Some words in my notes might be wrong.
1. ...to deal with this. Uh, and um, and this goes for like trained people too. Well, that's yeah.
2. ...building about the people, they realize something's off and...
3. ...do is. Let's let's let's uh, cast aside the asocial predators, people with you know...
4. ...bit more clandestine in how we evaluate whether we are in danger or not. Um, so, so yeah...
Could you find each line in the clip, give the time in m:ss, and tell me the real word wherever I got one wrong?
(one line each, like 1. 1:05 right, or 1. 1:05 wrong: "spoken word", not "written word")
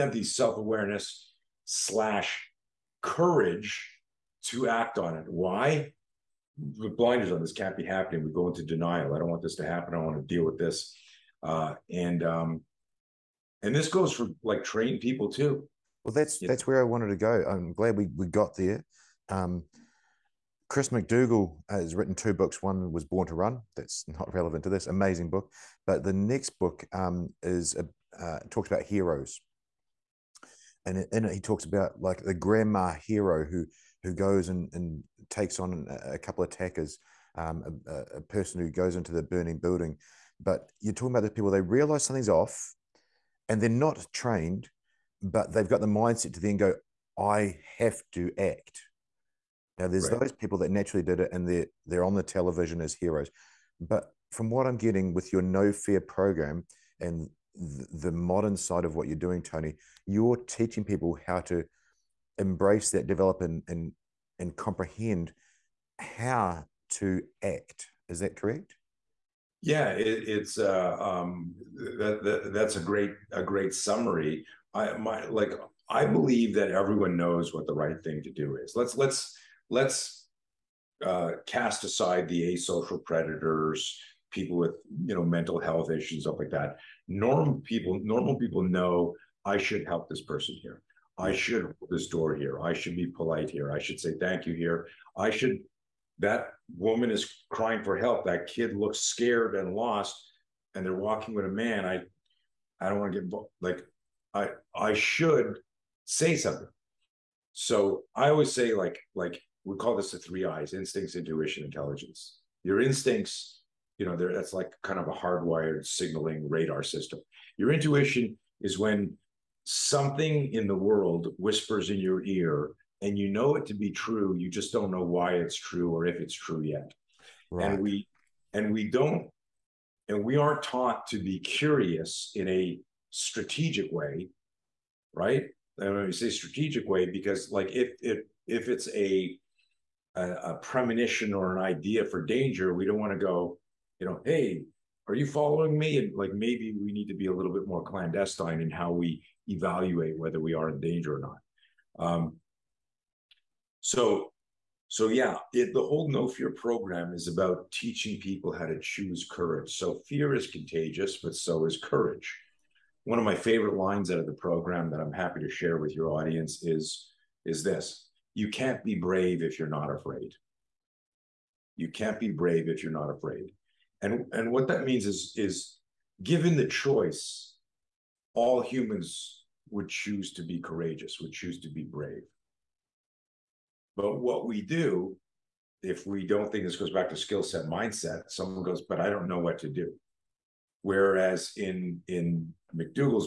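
1. 0:10 right
2. 0:40 wrong: "talking", not "building"
3. 1:18 right
4. 2:27 right.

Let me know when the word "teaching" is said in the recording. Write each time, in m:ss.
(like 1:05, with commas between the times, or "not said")
1:00, 2:37.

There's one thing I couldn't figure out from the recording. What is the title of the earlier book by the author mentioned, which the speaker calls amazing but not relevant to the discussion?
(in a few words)
Born to Run.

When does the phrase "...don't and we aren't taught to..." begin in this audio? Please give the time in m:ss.
2:08.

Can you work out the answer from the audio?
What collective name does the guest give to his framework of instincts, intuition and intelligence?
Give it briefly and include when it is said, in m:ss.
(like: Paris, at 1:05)
the three eyes, at 1:50.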